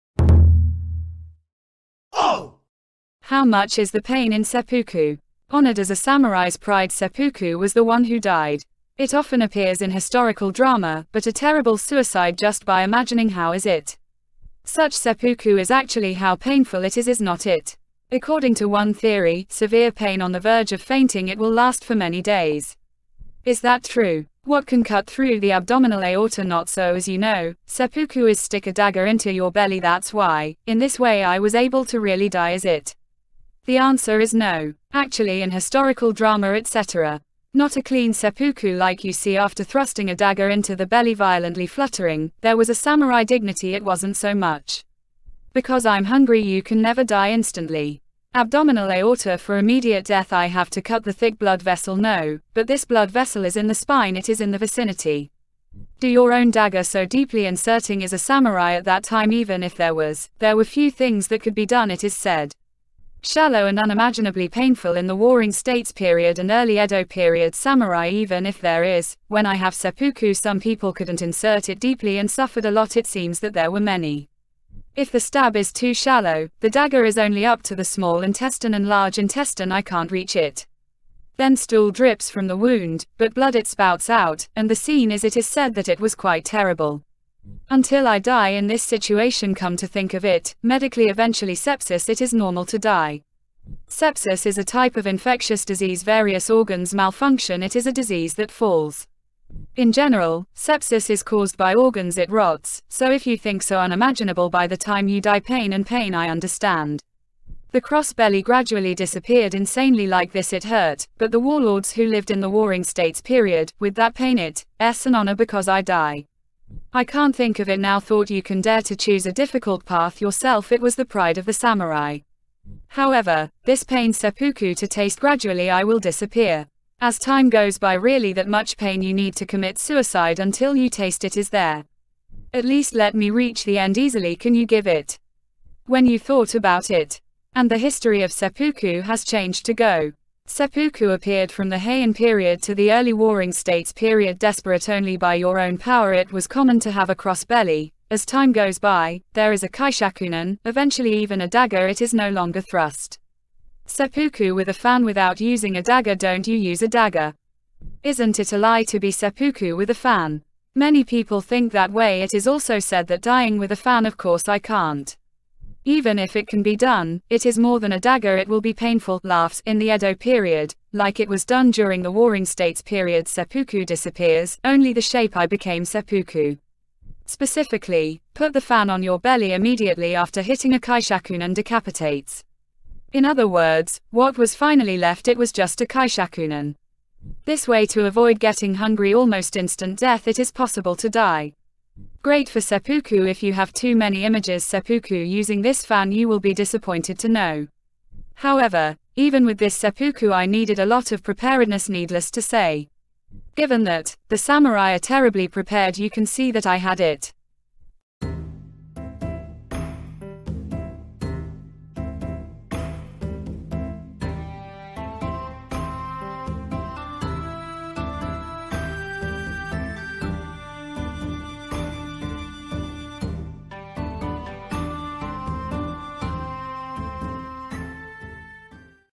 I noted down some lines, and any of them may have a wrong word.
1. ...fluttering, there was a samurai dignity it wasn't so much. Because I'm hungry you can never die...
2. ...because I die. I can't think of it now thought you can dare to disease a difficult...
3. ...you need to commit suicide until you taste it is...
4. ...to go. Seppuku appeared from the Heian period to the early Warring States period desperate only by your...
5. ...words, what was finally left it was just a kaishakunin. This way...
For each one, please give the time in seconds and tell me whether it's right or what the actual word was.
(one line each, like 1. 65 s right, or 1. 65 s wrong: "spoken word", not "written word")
1. 41 s right
2. 115 s wrong: "choose", not "disease"
3. 129 s right
4. 139 s right
5. 183 s right.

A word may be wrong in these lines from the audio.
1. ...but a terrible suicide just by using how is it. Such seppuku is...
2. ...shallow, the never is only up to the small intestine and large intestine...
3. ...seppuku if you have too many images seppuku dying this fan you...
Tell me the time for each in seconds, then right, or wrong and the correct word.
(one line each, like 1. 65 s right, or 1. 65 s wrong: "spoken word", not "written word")
1. 11 s wrong: "imagining", not "using"
2. 75 s wrong: "dagger", not "never"
3. 192 s wrong: "using", not "dying".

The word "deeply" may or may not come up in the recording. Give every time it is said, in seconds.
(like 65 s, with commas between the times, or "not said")
57 s, 71 s.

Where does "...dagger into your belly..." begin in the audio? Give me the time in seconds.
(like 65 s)
28 s.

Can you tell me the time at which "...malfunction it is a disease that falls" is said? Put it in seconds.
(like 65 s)
96 s.